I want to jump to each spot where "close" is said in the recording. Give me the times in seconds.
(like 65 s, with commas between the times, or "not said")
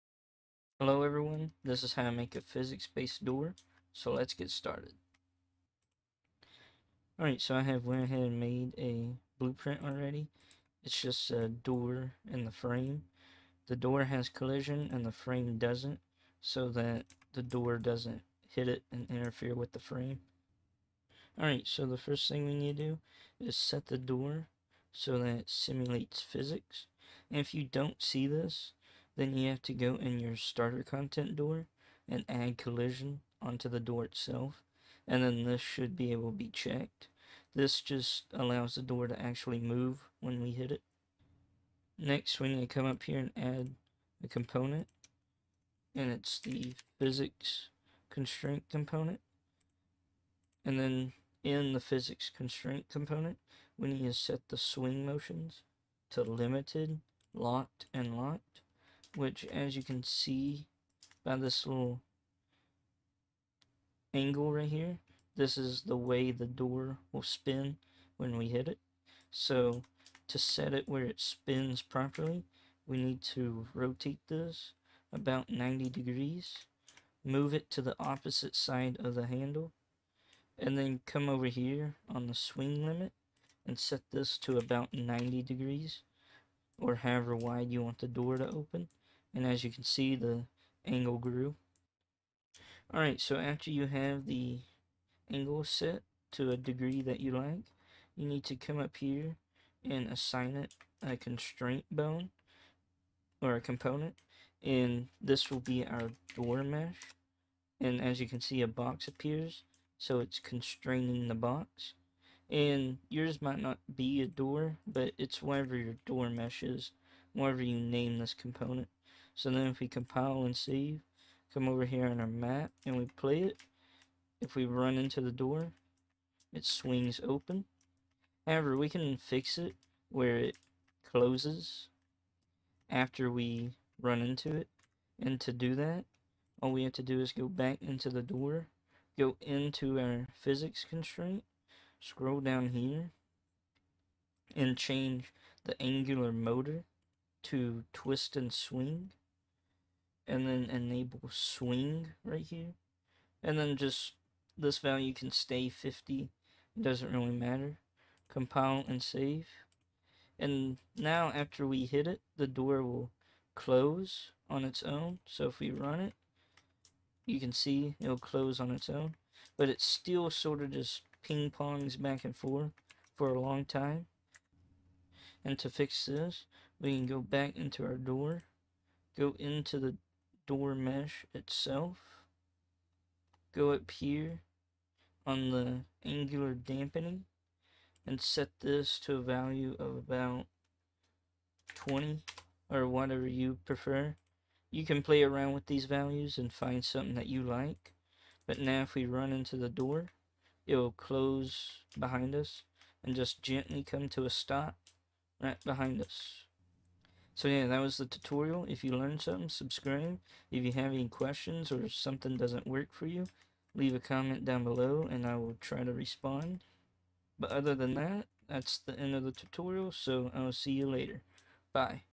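131 s, 163 s, 168 s, 200 s.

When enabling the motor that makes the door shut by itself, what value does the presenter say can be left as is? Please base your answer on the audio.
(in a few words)
50.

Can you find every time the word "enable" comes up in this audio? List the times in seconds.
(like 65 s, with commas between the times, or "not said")
150 s.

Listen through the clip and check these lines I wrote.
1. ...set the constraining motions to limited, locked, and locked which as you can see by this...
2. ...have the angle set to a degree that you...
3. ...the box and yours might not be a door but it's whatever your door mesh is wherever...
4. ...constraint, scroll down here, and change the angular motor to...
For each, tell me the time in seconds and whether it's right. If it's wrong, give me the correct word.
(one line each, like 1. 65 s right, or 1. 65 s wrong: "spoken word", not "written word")
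1. 54 s wrong: "swing", not "constraining"
2. 93 s right
3. 111 s right
4. 140 s right.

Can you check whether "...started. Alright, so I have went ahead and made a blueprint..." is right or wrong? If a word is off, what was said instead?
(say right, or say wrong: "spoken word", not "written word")
right.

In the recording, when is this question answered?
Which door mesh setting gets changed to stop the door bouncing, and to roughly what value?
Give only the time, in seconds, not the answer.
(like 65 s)
186 s.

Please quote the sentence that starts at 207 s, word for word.
So yeah, that was the tutorial.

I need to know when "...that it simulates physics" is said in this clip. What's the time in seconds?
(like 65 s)
25 s.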